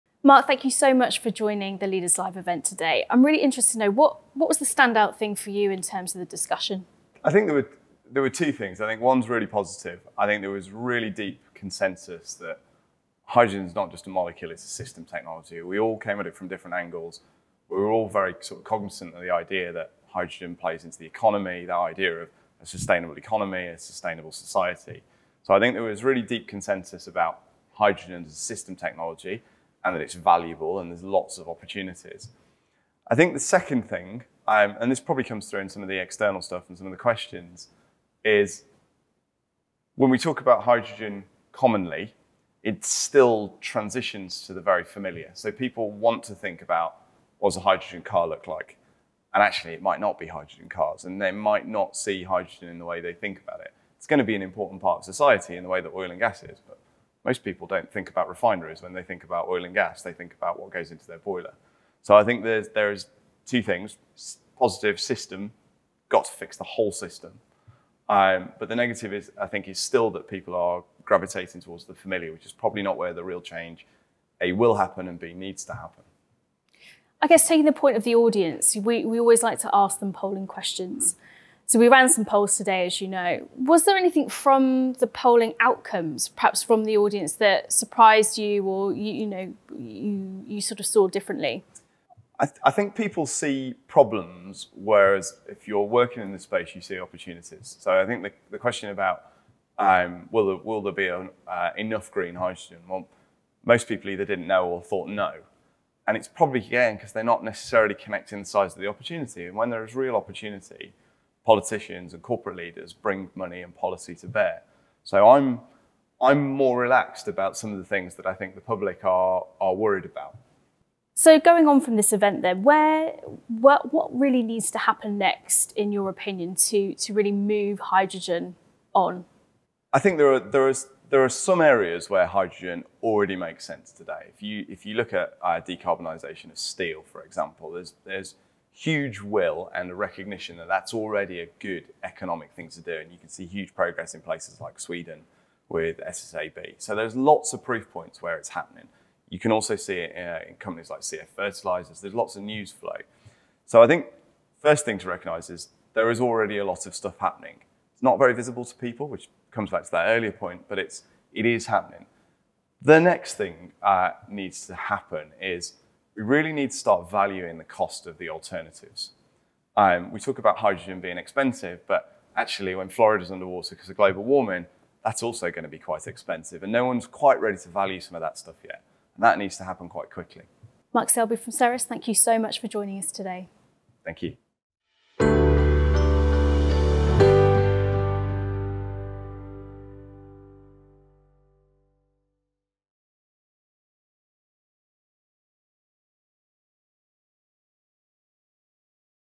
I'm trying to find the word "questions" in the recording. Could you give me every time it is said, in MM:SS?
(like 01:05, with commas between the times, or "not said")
00:36, 01:20, 01:38.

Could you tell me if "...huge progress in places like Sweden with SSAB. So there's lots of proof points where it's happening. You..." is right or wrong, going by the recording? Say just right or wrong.
right.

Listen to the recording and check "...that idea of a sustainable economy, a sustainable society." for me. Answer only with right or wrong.
right.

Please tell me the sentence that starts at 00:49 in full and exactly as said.
And actually, it might not be hydrogen cars, and they might not see hydrogen in the way they think about it.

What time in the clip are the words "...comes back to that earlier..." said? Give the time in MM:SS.
02:39.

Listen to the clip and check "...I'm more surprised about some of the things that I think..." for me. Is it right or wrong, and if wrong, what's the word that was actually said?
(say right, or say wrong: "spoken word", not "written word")
wrong: "relaxed", not "surprised".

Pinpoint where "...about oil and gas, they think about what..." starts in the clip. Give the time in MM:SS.
00:59.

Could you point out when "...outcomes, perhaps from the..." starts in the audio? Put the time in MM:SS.
01:25.